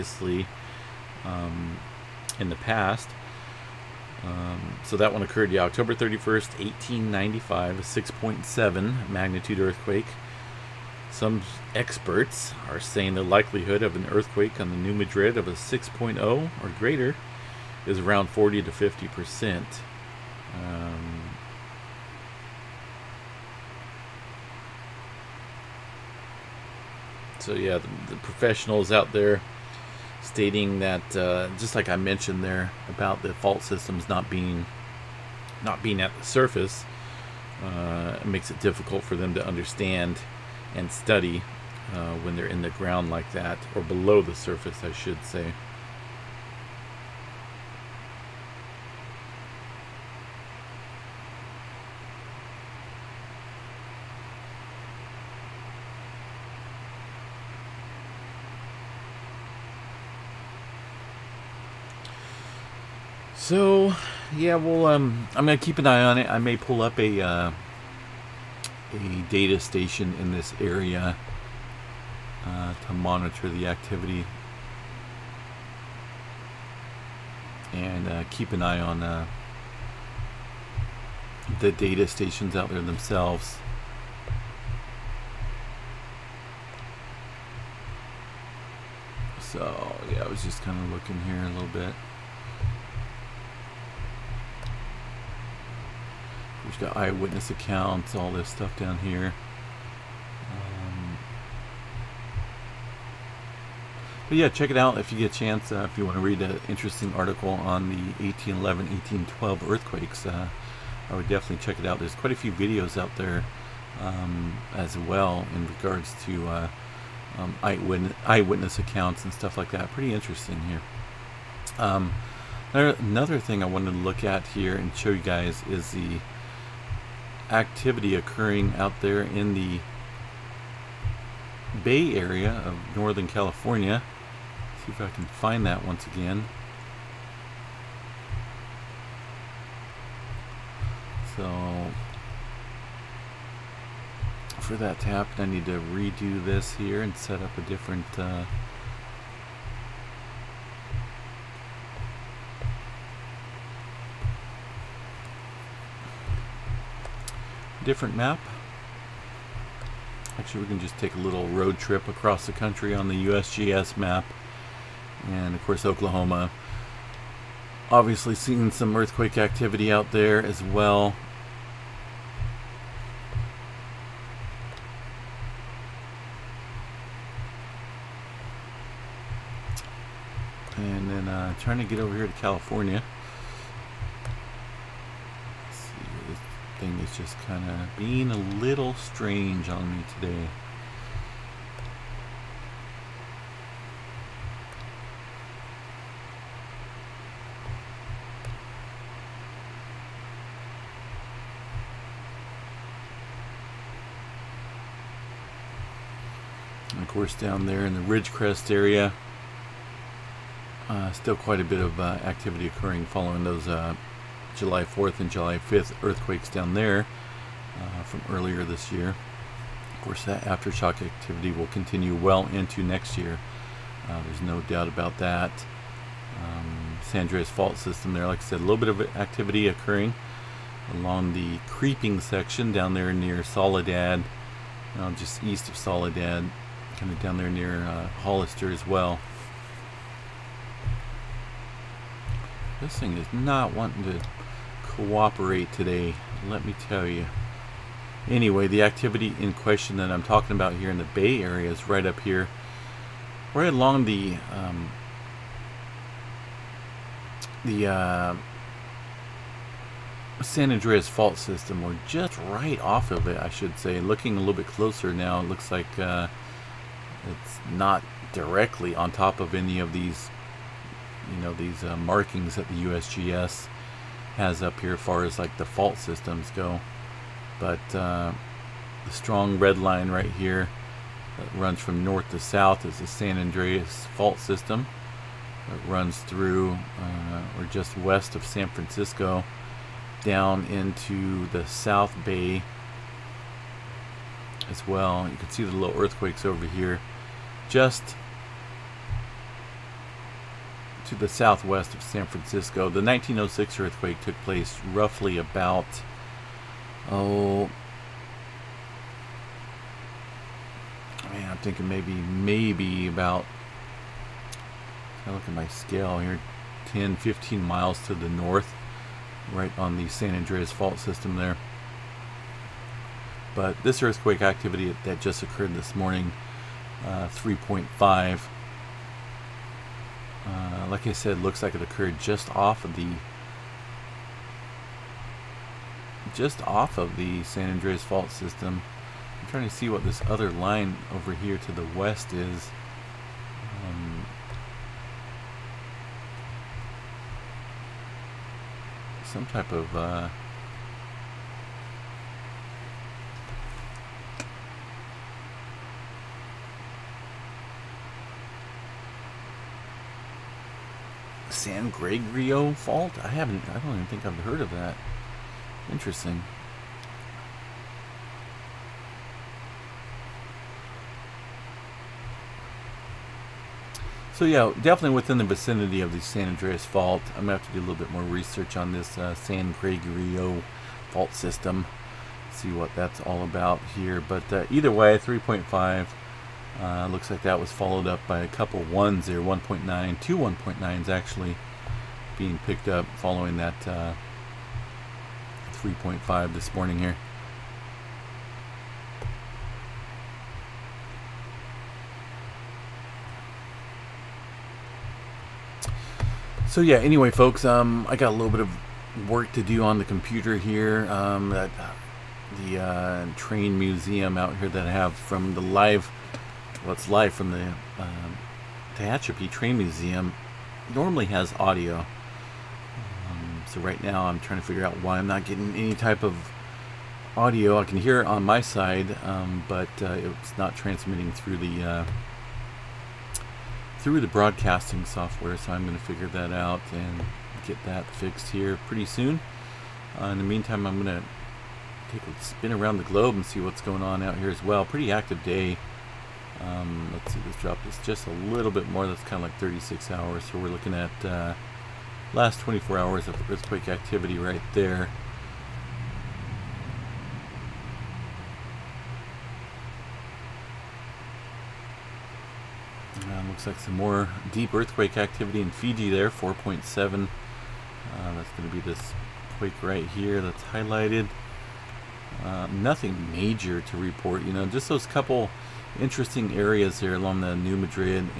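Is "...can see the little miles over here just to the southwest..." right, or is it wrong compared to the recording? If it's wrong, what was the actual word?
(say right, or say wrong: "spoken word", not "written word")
wrong: "earthquakes", not "miles".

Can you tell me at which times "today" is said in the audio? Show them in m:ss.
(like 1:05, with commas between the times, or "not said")
3:10, 4:05.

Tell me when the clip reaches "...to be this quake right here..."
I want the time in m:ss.
7:48.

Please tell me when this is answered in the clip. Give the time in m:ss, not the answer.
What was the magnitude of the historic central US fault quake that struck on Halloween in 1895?
0:07.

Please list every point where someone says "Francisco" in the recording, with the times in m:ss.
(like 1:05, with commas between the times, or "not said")
4:48, 5:02.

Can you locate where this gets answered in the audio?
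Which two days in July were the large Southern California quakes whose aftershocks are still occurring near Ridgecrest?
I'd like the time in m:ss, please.
3:34.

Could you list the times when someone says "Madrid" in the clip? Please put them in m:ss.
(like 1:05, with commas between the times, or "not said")
0:14, 7:57.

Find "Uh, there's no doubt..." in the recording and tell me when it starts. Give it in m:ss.
3:44.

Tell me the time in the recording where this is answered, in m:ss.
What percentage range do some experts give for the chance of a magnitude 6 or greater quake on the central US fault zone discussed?
0:18.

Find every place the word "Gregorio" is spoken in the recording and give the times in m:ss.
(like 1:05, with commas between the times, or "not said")
6:01, 6:19.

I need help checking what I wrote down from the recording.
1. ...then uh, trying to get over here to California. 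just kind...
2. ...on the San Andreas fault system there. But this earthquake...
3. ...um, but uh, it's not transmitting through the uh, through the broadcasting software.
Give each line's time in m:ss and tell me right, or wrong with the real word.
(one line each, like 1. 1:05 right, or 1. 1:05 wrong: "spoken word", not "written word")
1. 3:01 right
2. 5:19 right
3. 7:09 right.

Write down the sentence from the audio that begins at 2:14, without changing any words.
Let's see if I can find that once again.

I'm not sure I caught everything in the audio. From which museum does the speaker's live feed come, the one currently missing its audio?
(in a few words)
Tehachapi Train Museum.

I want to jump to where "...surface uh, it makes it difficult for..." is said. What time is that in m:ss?
0:36.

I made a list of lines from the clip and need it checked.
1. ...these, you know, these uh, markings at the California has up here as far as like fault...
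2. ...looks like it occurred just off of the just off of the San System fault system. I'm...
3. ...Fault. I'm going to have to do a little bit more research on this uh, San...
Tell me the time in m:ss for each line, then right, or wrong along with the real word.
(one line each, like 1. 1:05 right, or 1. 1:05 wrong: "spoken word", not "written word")
1. 4:29 wrong: "USGS", not "California"
2. 5:31 wrong: "Andreas", not "System"
3. 6:16 right.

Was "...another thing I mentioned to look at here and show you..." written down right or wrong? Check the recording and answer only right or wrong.
wrong.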